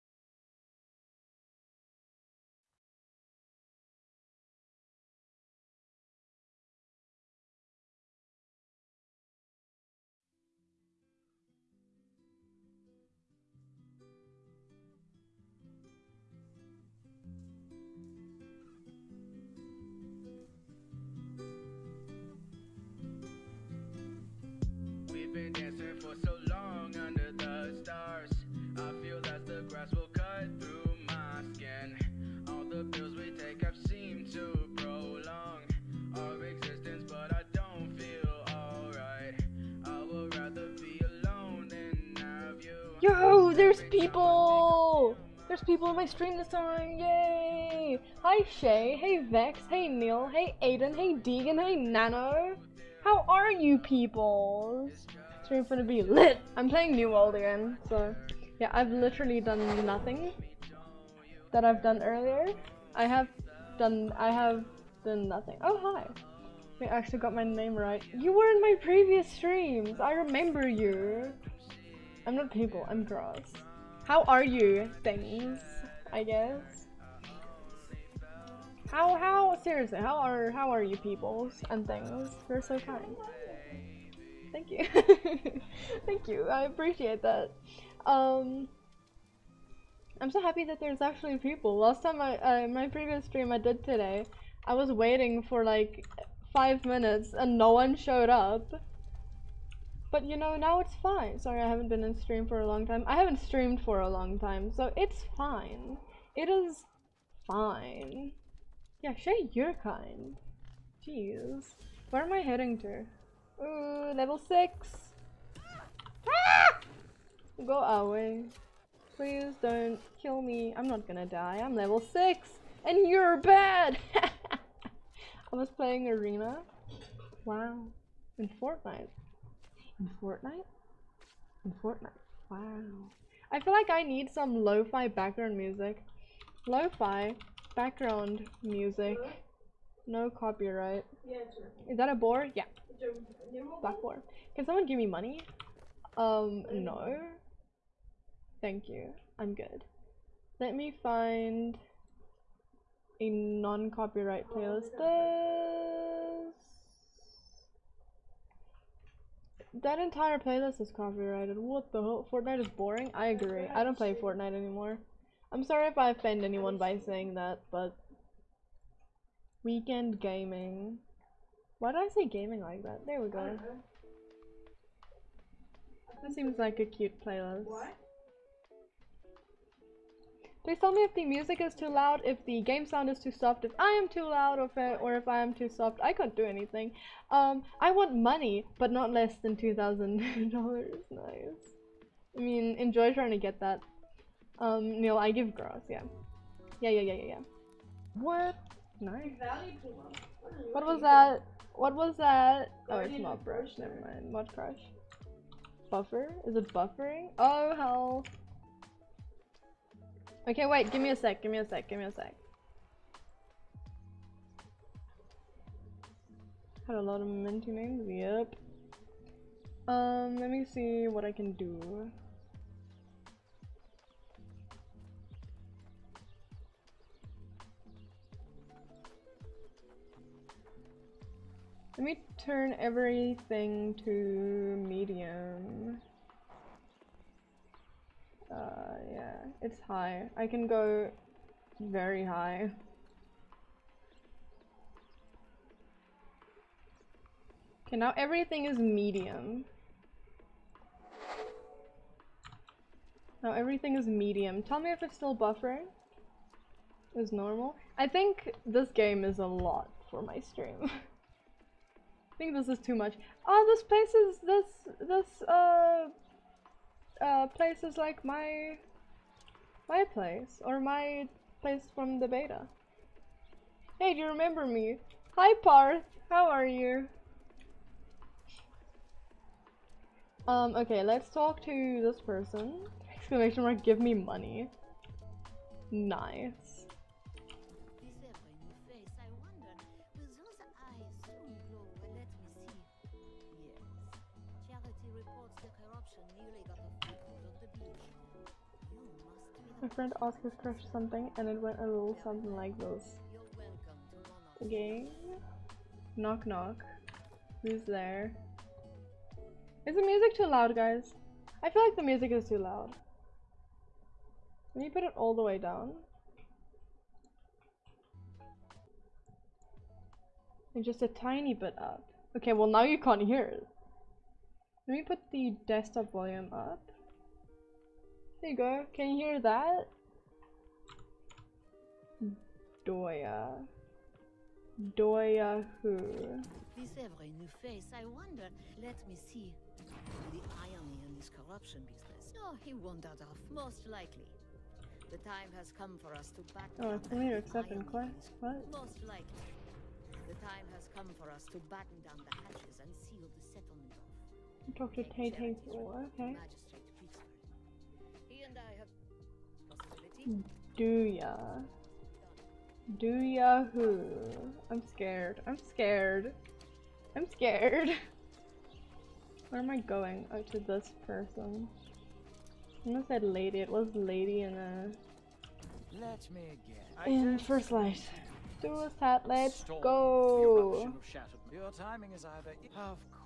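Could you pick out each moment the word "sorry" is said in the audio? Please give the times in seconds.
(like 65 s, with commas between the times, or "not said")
101 s, 165 s.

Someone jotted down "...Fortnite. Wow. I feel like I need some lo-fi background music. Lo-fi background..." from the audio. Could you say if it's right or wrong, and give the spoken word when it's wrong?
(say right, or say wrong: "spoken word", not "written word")
right.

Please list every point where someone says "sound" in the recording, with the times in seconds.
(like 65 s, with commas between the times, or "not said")
182 s.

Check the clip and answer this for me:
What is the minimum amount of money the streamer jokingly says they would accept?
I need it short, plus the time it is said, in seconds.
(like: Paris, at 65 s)
$2,000, at 189 s.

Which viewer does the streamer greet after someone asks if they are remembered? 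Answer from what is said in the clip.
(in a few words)
Parth.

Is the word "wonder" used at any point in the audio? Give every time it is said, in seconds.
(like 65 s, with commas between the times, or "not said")
338 s.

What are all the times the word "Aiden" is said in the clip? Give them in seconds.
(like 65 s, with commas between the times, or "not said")
50 s.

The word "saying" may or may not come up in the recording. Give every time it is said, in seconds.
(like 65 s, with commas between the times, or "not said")
167 s.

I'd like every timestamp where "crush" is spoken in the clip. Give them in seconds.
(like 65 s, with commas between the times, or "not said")
204 s, 300 s.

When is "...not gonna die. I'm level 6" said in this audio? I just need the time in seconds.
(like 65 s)
120 s.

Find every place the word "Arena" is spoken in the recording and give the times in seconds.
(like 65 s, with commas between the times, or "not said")
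126 s.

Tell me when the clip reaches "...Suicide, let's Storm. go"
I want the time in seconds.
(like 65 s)
378 s.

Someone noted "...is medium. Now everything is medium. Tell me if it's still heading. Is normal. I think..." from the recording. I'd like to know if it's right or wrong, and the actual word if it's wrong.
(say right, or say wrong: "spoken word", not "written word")
wrong: "buffering", not "heading".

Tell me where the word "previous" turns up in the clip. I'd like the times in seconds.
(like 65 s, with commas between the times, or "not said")
68 s, 92 s.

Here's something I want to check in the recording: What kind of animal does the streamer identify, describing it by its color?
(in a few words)
Black boar.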